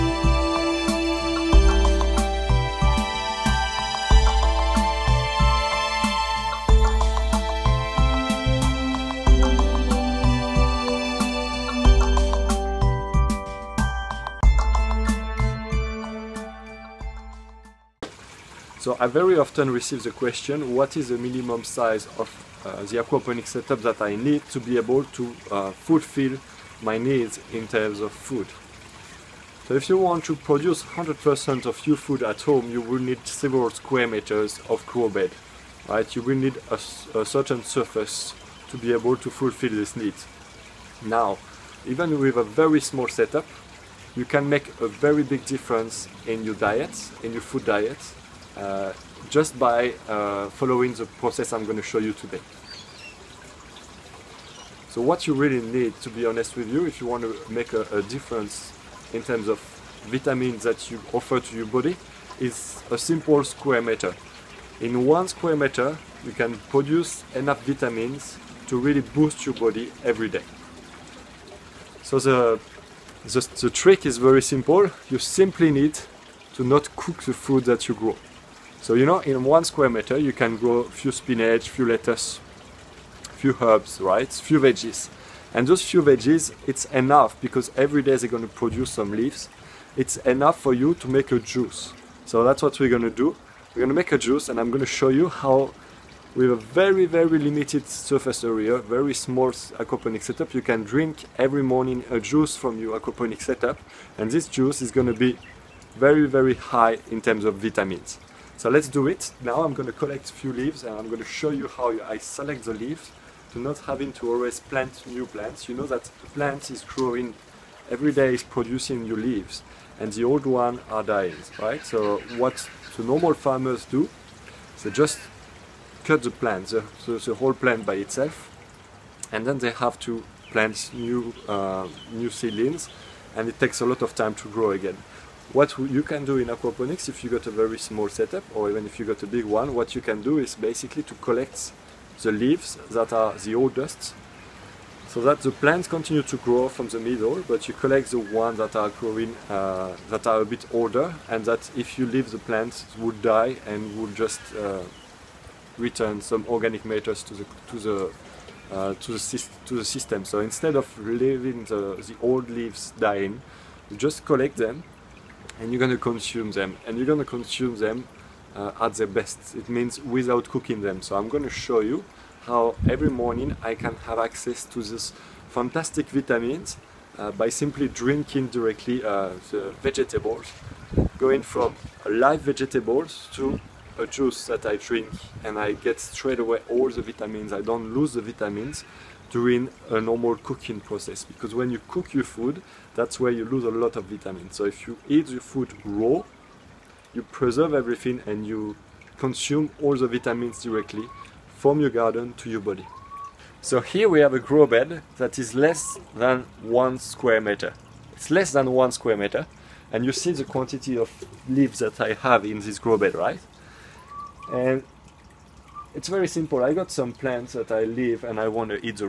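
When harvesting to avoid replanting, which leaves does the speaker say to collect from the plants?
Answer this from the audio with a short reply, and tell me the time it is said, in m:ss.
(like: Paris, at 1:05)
The oldest, at 2:23.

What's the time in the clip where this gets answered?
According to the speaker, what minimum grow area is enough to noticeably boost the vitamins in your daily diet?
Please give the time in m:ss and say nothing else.
1:02.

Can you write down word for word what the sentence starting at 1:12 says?
So the, the, the trick is very simple.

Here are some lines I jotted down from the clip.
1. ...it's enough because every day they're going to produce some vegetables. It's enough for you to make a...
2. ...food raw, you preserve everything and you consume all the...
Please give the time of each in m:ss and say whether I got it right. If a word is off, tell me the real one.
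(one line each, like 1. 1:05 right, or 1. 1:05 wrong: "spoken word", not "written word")
1. 1:26 wrong: "leaves", not "vegetables"
2. 3:15 right.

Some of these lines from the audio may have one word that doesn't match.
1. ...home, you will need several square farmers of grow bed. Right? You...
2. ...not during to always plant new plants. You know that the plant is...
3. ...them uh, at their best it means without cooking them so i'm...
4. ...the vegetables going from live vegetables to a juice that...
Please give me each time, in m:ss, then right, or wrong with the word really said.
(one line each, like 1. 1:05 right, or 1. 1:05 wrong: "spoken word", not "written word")
1. 0:32 wrong: "meters", not "farmers"
2. 1:53 wrong: "having", not "during"
3. 2:47 right
4. 2:59 right.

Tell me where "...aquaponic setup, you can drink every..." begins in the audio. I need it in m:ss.
1:39.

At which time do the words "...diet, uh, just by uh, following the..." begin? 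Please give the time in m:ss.
0:47.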